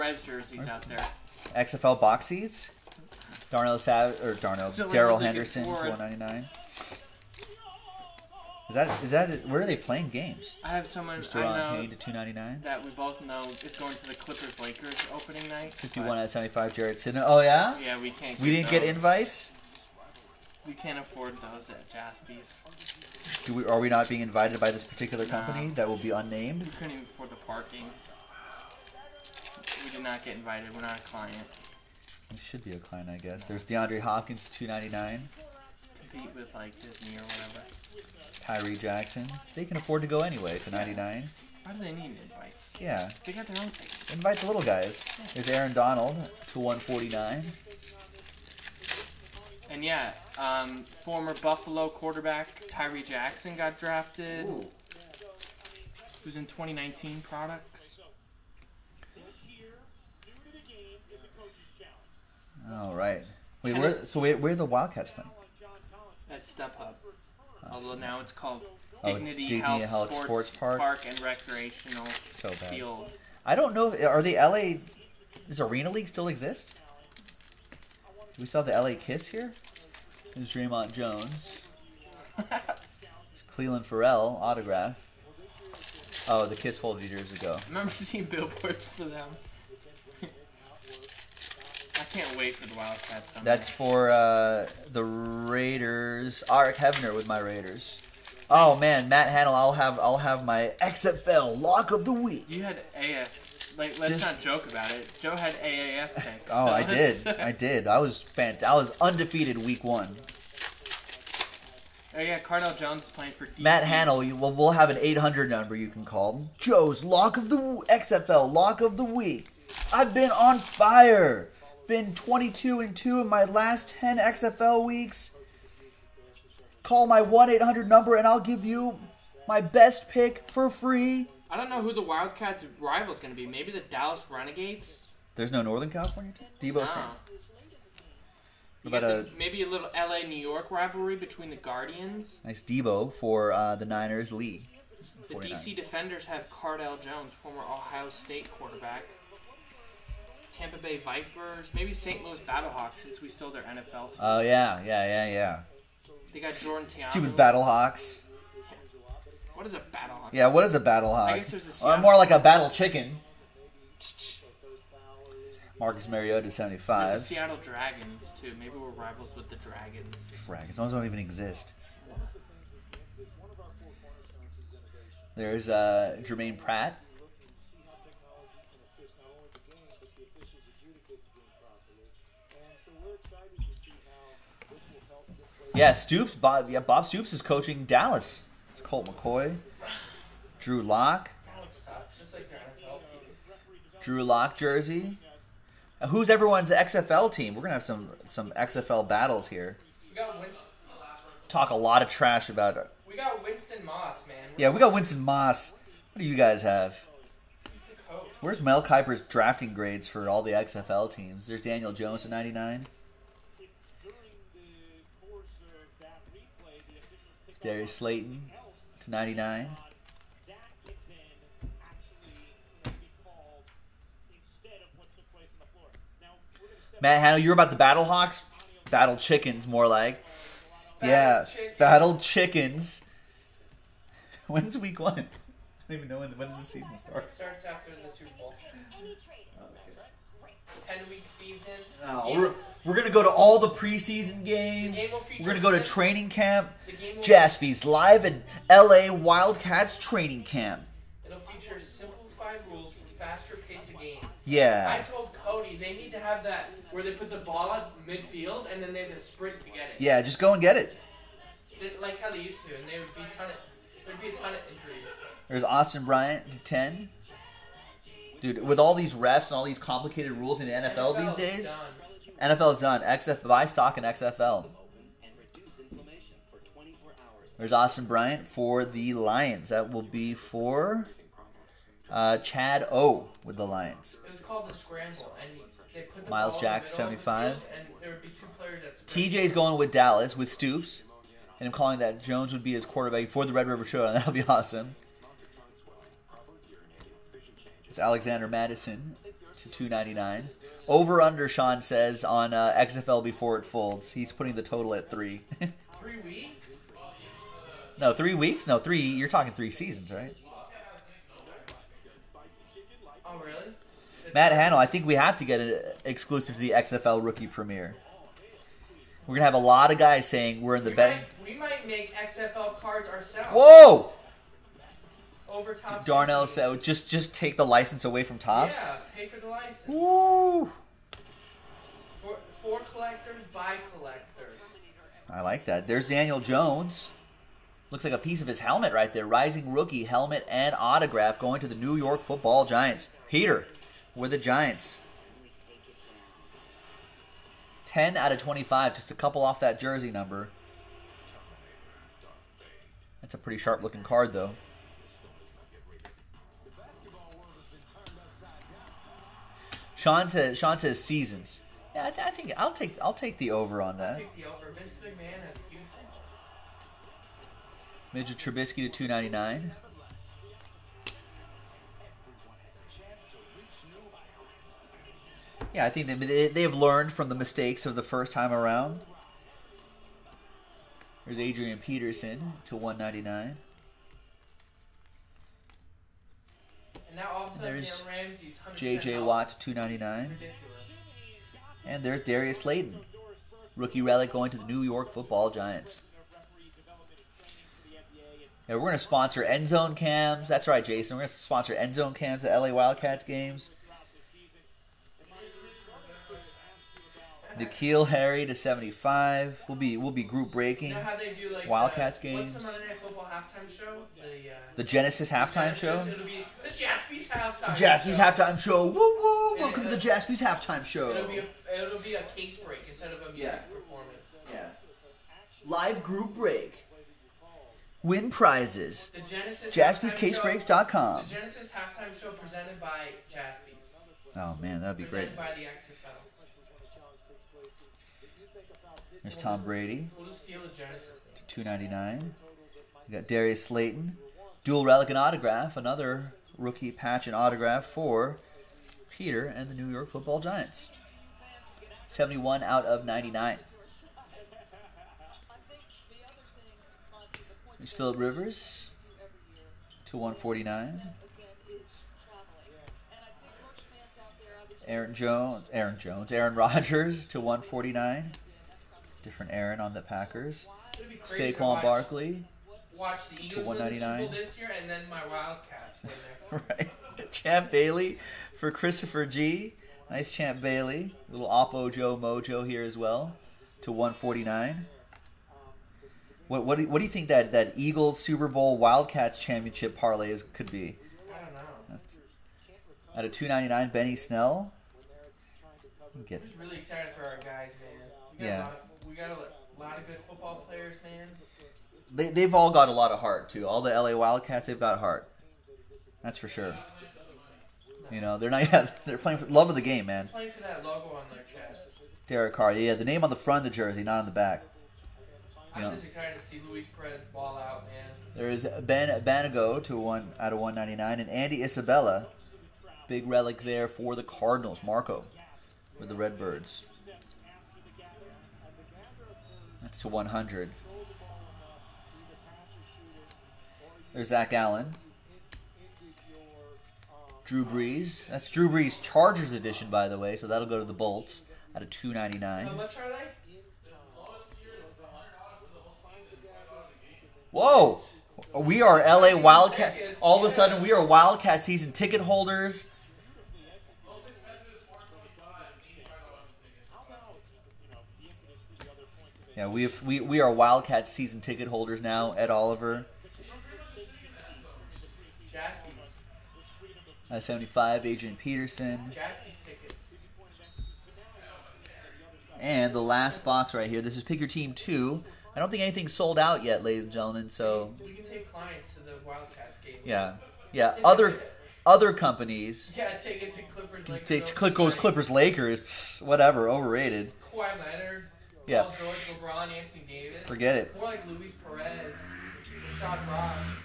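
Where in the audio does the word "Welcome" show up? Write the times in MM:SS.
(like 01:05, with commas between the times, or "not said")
06:59.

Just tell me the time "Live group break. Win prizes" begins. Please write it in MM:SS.
07:05.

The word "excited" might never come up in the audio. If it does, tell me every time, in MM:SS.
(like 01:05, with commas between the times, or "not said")
08:16, 08:36.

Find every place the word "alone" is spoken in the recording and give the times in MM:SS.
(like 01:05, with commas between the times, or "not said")
not said.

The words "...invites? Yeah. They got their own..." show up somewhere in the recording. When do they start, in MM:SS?
00:42.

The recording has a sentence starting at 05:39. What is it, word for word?
Rising rookie helmet and autograph going to the New York Football Giants.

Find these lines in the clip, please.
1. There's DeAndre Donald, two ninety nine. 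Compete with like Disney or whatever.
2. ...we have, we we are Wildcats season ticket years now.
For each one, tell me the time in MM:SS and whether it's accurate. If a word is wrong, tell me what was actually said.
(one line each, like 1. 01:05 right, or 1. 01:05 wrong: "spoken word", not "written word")
1. 00:33 wrong: "Hopkins", not "Donald"
2. 09:19 wrong: "holders", not "years".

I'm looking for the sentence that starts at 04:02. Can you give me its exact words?
we're, we're gonna go to all the preseason games.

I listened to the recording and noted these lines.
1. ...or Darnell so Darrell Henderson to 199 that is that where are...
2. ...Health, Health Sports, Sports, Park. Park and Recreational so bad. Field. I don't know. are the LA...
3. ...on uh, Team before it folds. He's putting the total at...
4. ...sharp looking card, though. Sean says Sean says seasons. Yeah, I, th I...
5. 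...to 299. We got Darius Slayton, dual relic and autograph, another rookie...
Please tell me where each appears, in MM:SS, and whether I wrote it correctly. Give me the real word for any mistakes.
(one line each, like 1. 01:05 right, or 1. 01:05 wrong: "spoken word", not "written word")
1. 00:04 right
2. 01:09 right
3. 05:02 wrong: "XFL", not "Team"
4. 05:53 right
5. 07:20 right.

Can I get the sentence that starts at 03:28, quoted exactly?
Where's Mel Kiper's drafting grades for all the XFL teams?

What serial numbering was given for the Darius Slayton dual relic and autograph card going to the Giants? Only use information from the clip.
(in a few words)
71/99.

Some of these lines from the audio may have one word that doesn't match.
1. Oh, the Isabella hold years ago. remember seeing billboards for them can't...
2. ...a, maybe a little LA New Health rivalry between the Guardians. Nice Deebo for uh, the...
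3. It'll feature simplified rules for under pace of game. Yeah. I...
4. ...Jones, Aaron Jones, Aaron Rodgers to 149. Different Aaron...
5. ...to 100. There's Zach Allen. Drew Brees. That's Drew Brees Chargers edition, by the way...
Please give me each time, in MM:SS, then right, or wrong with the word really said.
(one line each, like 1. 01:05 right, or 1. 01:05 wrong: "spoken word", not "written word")
1. 01:26 wrong: "Kiss", not "Isabella"
2. 02:19 wrong: "York", not "Health"
3. 04:11 wrong: "faster", not "under"
4. 07:45 right
5. 08:49 right.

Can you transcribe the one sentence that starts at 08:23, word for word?
All the LA Wildcats, they've got heart.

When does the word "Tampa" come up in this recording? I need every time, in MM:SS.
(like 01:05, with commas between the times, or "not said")
02:30.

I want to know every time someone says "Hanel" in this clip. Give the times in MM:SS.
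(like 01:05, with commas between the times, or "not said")
01:39, 01:53.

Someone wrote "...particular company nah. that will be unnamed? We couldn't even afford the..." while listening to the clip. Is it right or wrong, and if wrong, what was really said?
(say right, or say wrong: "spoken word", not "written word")
right.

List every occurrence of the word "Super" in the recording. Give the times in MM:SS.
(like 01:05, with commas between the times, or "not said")
03:58, 08:08.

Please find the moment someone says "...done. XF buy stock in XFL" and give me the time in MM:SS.
04:32.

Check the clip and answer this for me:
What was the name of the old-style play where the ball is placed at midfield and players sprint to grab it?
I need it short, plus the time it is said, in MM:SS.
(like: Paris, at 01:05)
the scramble, at 04:44.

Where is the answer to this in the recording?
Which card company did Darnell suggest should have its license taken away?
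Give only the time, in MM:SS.
05:28.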